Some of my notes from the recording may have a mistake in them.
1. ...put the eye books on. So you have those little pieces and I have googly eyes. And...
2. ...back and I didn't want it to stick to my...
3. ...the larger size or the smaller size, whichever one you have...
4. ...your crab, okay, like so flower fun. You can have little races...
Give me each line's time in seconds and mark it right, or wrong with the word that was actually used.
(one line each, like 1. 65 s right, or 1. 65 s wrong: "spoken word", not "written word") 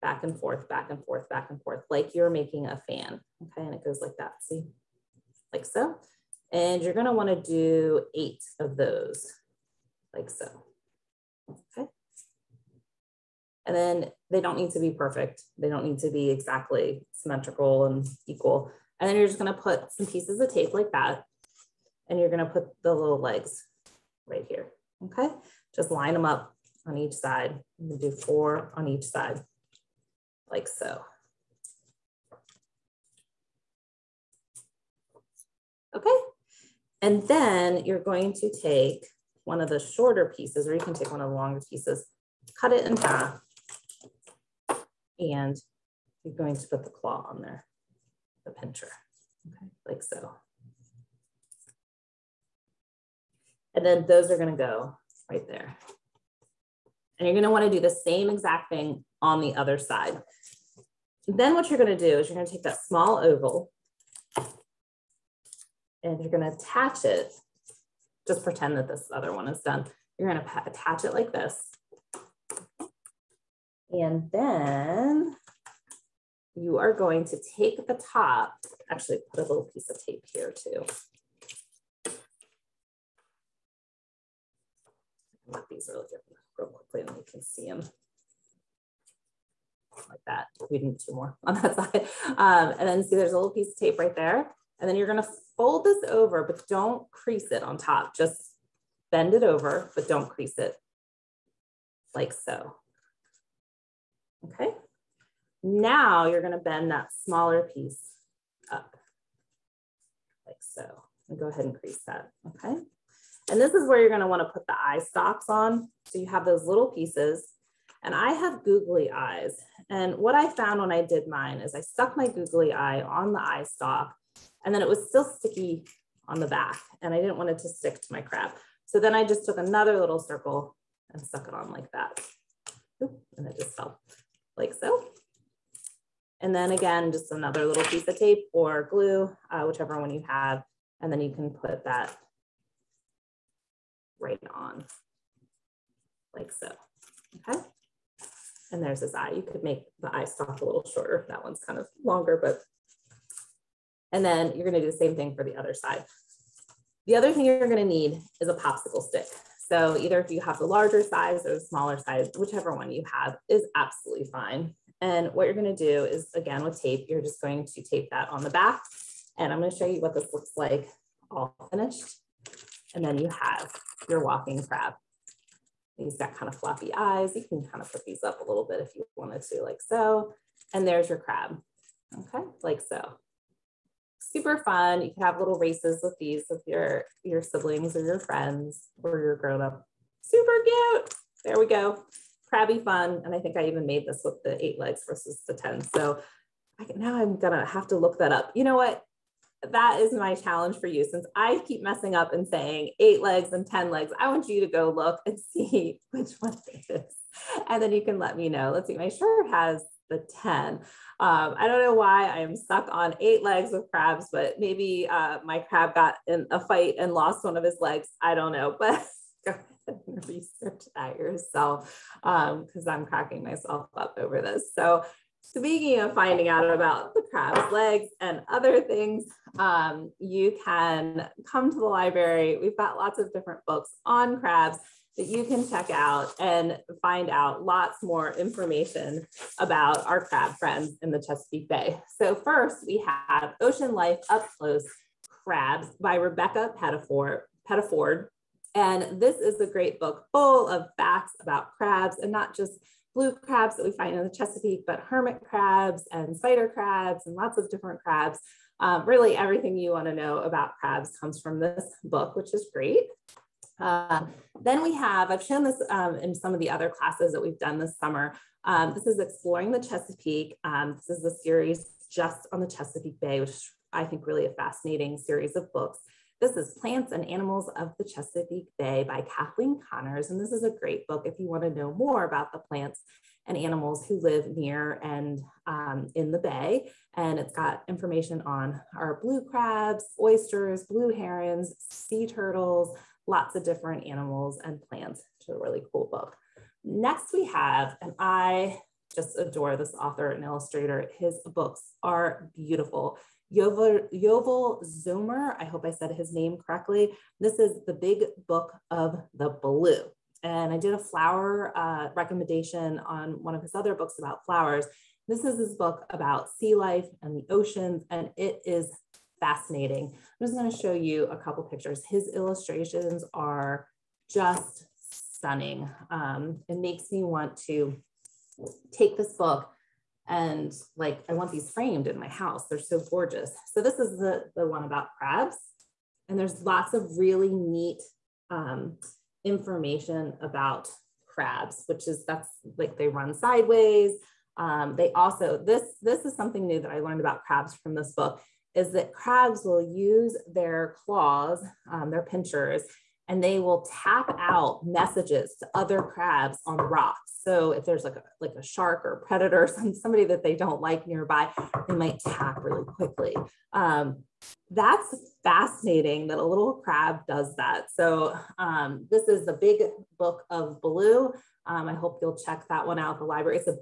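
1. 114 s wrong: "stalks", not "books"
2. 126 s right
3. 160 s right
4. 181 s wrong: "super", not "flower".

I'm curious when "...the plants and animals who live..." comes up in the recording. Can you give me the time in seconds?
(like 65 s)
282 s.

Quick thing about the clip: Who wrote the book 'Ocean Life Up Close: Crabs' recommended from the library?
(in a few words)
Rebecca Pettiford.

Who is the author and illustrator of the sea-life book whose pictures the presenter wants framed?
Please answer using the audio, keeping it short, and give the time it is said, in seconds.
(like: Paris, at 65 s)
Yuval Zommer, at 304 s.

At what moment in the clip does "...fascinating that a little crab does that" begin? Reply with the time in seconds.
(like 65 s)
365 s.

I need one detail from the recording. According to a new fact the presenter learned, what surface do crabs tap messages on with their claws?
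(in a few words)
Rocks.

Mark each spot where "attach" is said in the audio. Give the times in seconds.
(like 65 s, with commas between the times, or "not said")
66 s, 70 s.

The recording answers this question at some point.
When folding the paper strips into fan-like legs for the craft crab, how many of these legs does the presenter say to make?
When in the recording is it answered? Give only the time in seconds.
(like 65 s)
8 s.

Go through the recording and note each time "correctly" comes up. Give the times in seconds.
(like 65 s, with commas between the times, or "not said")
306 s.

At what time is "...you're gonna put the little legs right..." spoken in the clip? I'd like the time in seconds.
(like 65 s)
22 s.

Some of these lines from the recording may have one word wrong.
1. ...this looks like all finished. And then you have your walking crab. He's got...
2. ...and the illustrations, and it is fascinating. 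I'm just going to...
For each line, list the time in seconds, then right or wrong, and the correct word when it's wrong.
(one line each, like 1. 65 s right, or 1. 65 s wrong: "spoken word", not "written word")
1. 170 s right
2. 317 s wrong: "oceans", not "illustrations".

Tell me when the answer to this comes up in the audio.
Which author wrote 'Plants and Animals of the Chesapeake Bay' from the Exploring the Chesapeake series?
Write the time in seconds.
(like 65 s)
279 s.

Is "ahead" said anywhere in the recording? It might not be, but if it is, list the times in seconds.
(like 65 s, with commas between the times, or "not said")
111 s, 219 s.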